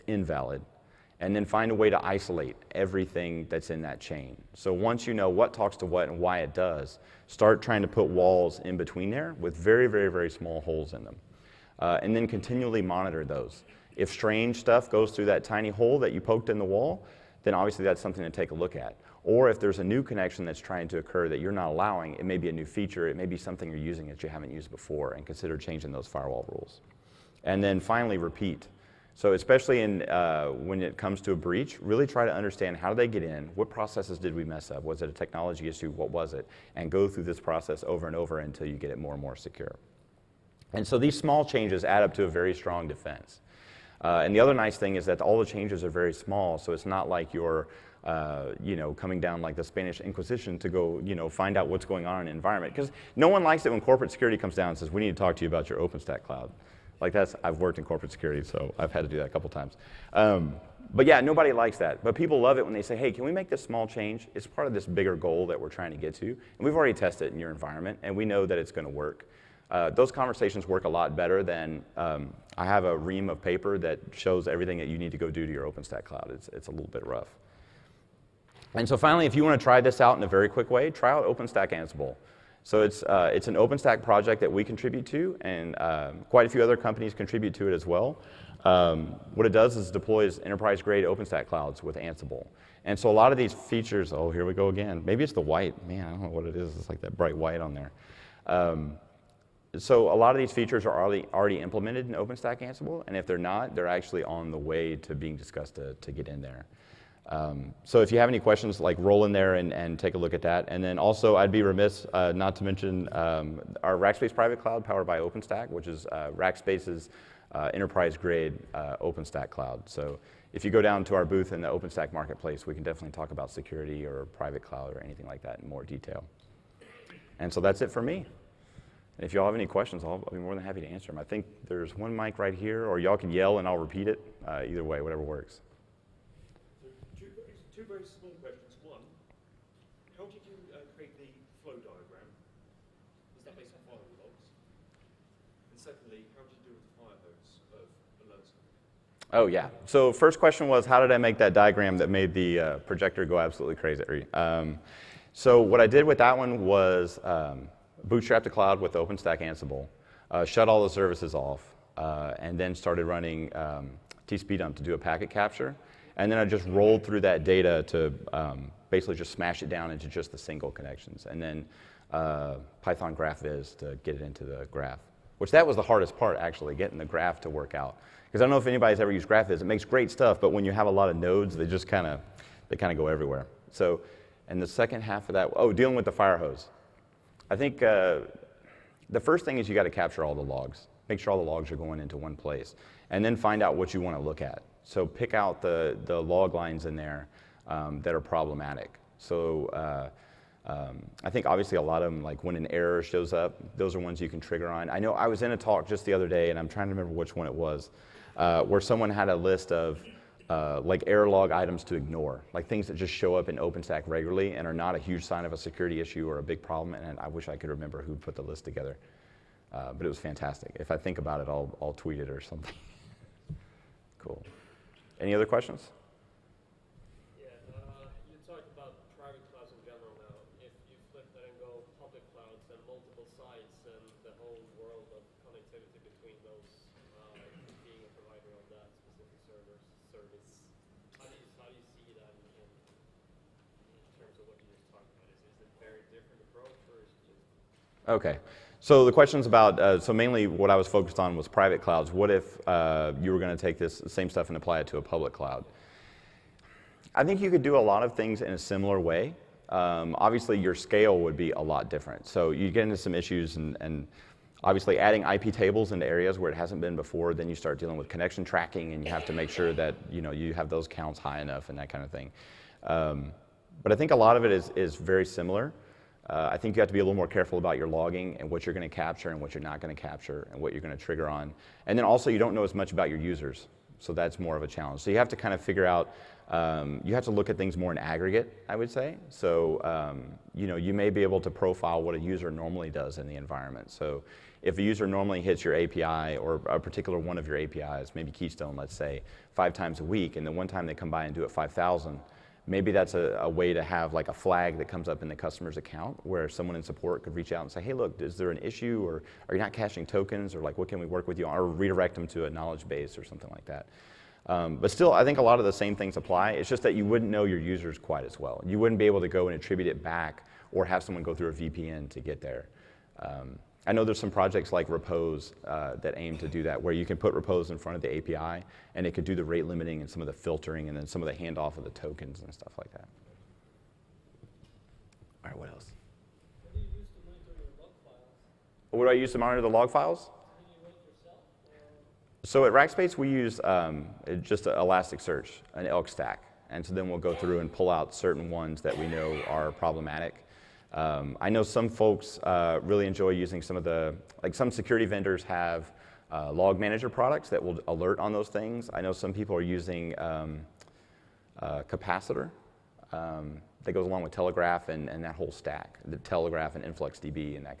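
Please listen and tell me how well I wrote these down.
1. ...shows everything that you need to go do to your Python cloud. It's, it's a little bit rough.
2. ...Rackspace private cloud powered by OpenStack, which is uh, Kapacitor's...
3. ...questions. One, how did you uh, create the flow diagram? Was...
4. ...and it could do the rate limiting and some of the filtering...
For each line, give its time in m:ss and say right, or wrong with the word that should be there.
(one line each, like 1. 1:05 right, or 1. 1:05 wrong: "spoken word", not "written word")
1. 1:14 wrong: "OpenStack", not "Python"
2. 1:53 wrong: "Rackspace", not "Kapacitor"
3. 2:18 right
4. 5:28 right.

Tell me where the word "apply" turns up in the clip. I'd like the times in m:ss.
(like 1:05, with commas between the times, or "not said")
4:14, 5:16.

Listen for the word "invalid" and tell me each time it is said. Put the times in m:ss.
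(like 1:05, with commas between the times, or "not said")
0:00.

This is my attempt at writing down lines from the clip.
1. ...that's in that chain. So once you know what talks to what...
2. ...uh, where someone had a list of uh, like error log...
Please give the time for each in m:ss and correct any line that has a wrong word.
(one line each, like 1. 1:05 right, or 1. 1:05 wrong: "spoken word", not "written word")
1. 0:03 right
2. 3:28 right.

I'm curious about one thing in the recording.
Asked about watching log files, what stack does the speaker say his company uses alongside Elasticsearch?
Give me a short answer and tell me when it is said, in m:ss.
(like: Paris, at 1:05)
ELK stack, at 5:45.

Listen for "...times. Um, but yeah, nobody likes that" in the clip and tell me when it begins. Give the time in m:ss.
0:59.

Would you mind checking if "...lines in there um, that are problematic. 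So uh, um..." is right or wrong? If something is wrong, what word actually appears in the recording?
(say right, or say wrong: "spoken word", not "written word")
right.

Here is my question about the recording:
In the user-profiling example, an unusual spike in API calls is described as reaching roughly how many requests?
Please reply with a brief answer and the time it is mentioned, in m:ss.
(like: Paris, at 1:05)
5,000, at 5:01.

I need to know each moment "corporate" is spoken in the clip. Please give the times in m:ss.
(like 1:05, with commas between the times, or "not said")
0:53, 0:57.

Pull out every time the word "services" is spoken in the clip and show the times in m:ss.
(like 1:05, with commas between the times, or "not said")
2:40, 4:00.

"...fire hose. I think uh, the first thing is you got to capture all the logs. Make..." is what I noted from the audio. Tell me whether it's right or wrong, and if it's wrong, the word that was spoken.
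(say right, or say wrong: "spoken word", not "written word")
right.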